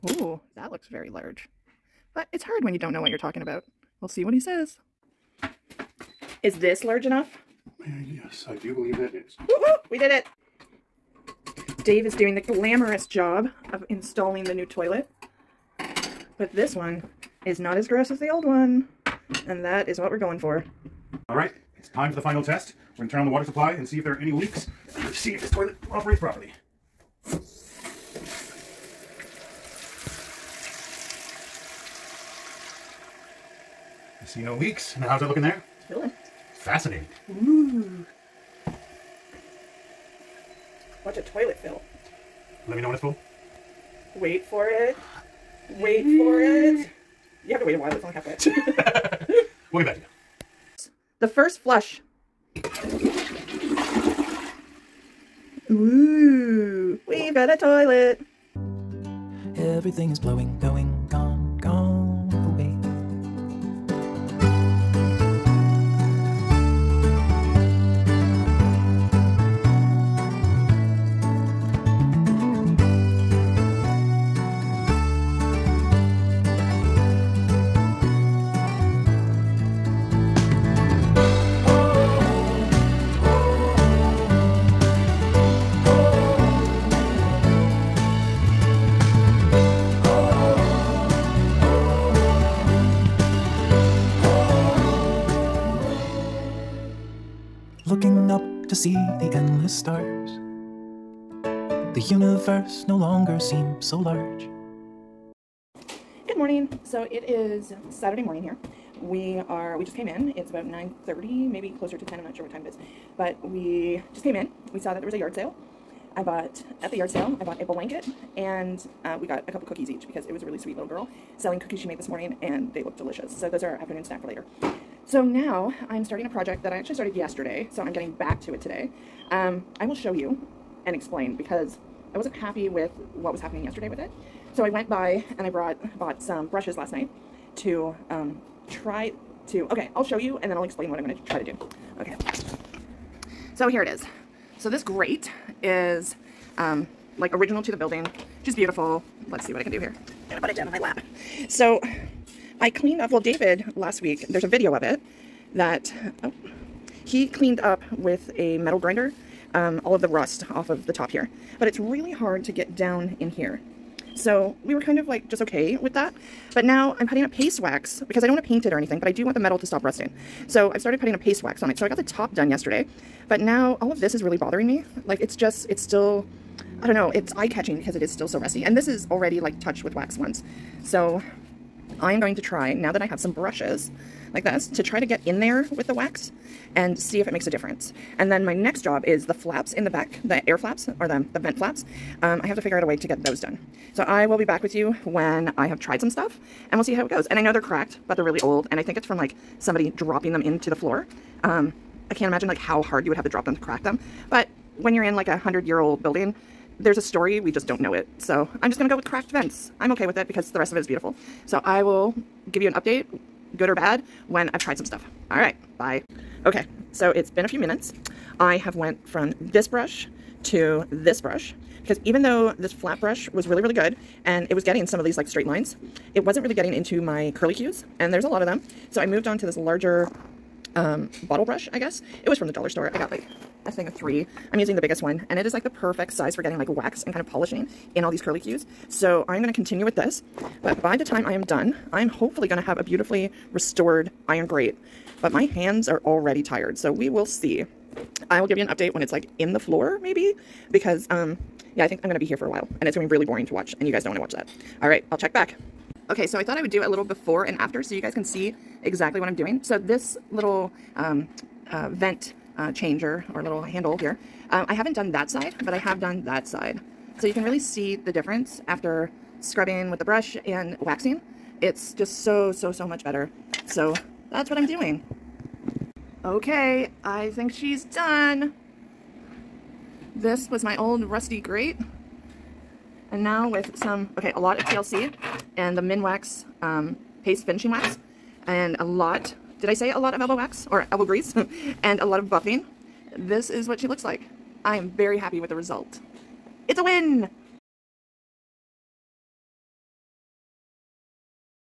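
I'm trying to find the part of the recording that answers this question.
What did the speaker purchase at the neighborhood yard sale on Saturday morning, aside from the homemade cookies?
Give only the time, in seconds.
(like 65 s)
117 s.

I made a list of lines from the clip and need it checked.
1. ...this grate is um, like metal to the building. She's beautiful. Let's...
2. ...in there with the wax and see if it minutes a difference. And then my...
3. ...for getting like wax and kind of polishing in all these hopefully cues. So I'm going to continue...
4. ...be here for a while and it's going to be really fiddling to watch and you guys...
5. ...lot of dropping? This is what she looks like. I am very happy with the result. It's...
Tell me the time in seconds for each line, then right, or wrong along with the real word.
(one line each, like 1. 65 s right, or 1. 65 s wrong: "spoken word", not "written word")
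1. 144 s wrong: "original", not "metal"
2. 185 s wrong: "makes", not "minutes"
3. 236 s wrong: "curly", not "hopefully"
4. 252 s wrong: "boring", not "fiddling"
5. 292 s wrong: "buffing", not "dropping".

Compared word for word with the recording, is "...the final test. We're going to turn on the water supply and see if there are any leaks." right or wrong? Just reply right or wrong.
right.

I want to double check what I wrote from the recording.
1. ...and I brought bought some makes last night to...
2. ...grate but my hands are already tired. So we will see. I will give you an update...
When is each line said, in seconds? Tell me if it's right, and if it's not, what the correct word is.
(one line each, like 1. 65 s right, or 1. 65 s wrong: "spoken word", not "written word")
1. 135 s wrong: "brushes", not "makes"
2. 244 s right.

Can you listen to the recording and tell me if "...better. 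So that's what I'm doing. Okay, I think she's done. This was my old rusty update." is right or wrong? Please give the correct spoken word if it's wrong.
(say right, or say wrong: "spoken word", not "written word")
wrong: "grate", not "update".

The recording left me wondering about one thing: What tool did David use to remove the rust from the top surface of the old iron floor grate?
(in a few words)
metal grinder.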